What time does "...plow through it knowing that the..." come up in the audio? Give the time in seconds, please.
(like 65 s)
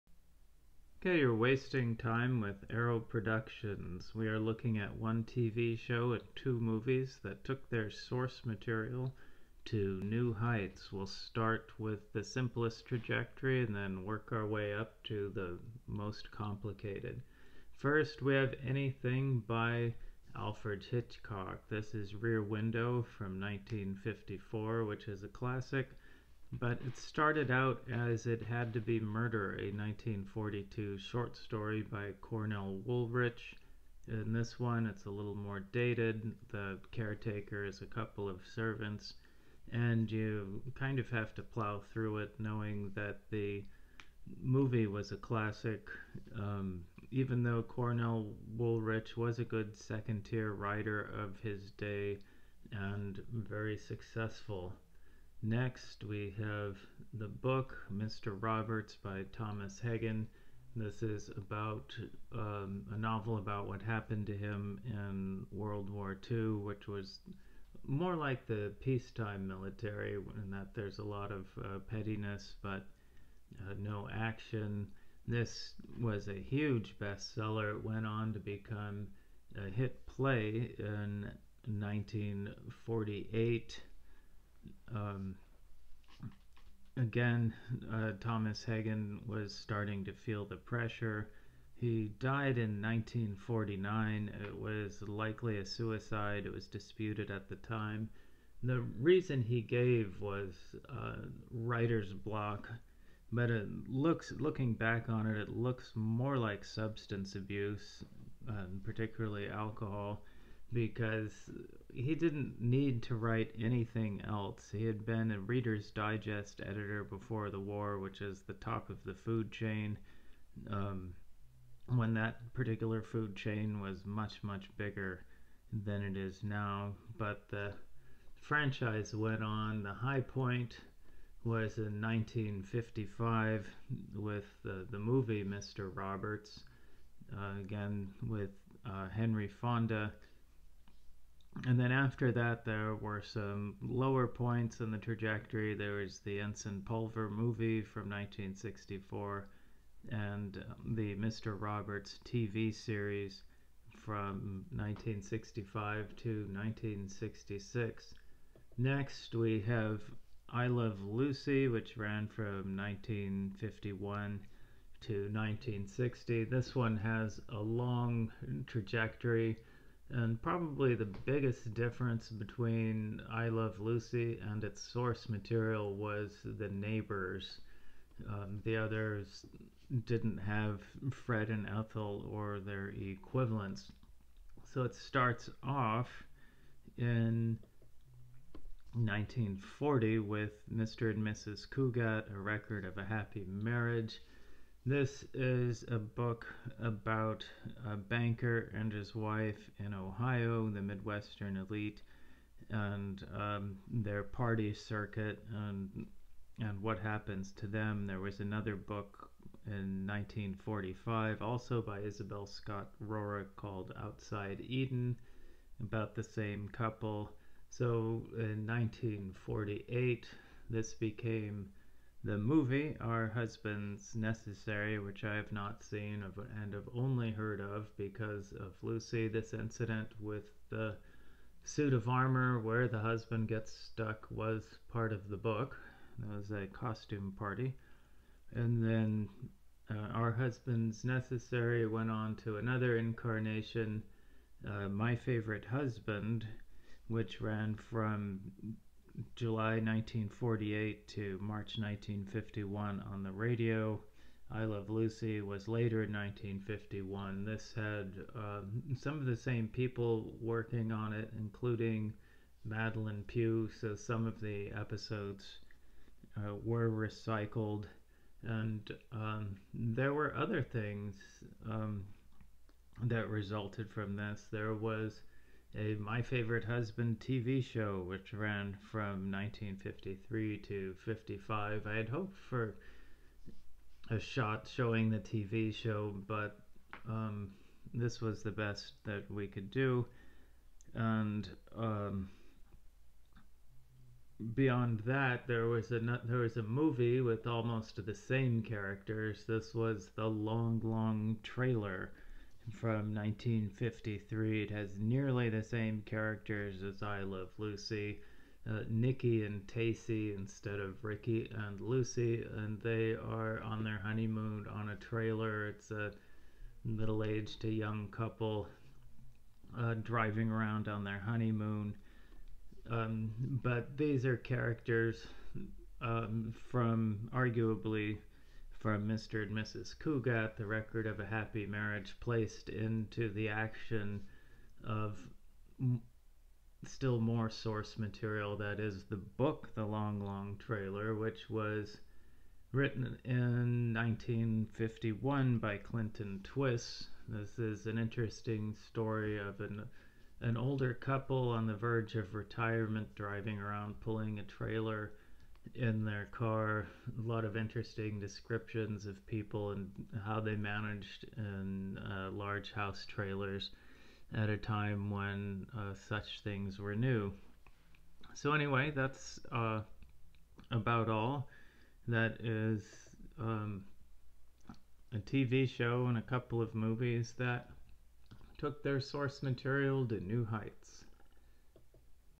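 41 s.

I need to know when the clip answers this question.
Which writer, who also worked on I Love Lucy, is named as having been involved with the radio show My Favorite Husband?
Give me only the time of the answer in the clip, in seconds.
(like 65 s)
262 s.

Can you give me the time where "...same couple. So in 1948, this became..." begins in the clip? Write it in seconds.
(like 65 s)
216 s.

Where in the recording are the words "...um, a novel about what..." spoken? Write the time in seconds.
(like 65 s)
62 s.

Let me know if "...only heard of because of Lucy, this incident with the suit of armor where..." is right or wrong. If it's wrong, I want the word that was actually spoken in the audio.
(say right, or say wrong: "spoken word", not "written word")
right.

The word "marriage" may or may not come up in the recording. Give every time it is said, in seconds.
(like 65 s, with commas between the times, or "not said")
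193 s, 331 s.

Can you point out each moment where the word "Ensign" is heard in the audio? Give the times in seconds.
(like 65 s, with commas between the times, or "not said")
146 s.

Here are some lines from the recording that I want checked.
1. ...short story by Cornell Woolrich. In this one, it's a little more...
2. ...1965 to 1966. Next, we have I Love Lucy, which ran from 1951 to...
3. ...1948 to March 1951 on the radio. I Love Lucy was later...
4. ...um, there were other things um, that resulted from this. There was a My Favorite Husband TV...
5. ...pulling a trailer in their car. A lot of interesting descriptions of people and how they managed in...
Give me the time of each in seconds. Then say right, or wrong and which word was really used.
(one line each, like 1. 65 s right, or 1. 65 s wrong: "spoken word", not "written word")
1. 30 s right
2. 154 s right
3. 249 s right
4. 269 s right
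5. 353 s right.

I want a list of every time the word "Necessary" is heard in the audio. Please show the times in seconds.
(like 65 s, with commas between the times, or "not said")
224 s, 241 s.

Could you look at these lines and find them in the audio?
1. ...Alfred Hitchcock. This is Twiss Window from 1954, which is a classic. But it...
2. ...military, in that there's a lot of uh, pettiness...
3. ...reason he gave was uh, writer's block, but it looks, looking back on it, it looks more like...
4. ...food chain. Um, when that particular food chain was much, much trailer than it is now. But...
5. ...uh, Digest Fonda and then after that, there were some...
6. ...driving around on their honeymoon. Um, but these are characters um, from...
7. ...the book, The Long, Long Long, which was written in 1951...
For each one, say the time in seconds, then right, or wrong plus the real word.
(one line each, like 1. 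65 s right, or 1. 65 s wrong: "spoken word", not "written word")
1. 20 s wrong: "Rear", not "Twiss"
2. 69 s right
3. 98 s right
4. 119 s wrong: "bigger", not "trailer"
5. 138 s wrong: "Henry", not "Digest"
6. 320 s right
7. 339 s wrong: "Trailer", not "Long".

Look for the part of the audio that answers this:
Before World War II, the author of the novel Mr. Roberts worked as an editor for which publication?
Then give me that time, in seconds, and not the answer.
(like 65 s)
115 s.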